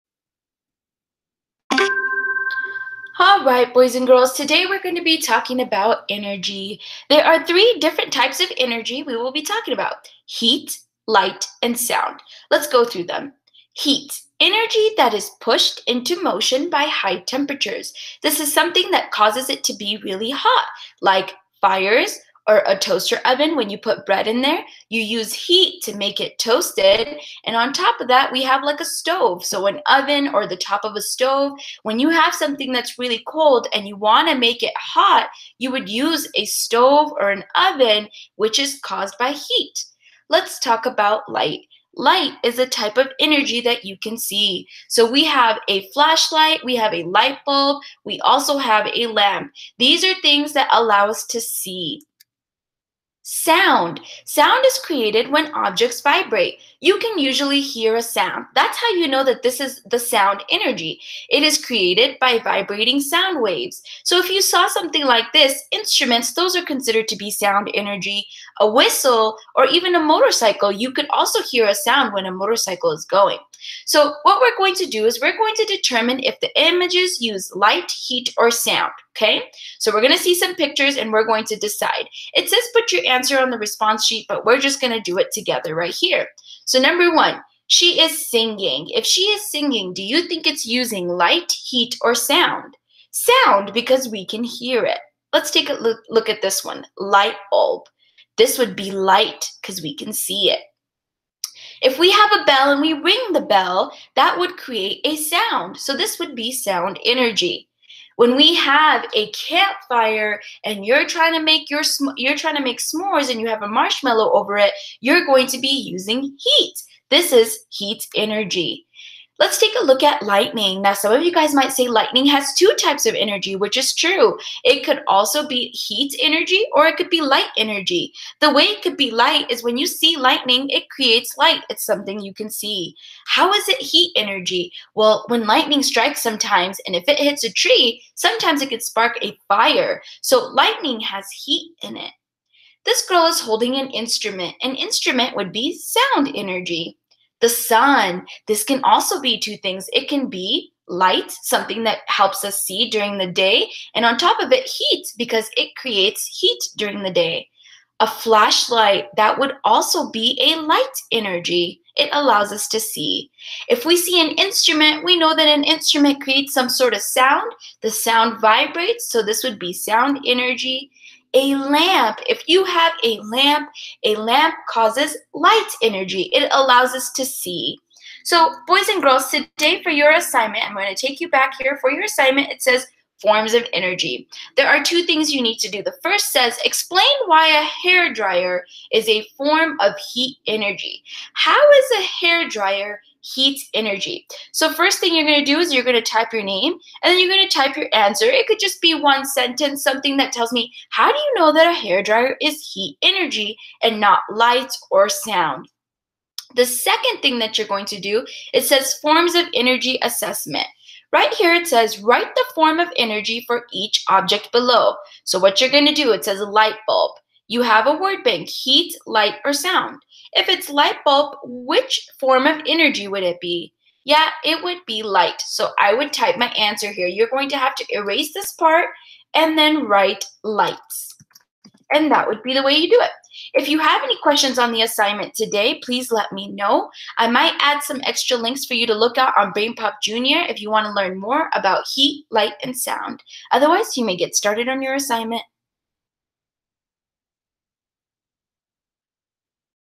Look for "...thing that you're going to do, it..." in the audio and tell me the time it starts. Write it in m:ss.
3:27.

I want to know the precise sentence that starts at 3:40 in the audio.
If it's light bulb, which form of energy would it be?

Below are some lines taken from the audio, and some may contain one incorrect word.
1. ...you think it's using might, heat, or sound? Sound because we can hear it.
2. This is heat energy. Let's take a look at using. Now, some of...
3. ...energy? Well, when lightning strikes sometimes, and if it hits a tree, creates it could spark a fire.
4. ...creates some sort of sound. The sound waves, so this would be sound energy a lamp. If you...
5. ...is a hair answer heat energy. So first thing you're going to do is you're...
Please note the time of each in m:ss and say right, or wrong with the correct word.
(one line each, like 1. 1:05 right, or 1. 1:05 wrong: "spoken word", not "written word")
1. 1:30 wrong: "light", not "might"
2. 1:57 wrong: "lightning", not "using"
3. 2:14 wrong: "sometimes", not "creates"
4. 2:46 wrong: "vibrates", not "waves"
5. 3:11 wrong: "dryer", not "answer".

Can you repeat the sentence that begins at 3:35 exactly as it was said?
So what you're going to do, it says a light bulb.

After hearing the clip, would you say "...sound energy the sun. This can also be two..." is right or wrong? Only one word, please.
right.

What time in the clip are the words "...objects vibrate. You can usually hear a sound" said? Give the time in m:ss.
0:55.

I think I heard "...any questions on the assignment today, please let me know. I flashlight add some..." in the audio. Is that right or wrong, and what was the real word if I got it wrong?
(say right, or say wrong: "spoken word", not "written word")
wrong: "might", not "flashlight".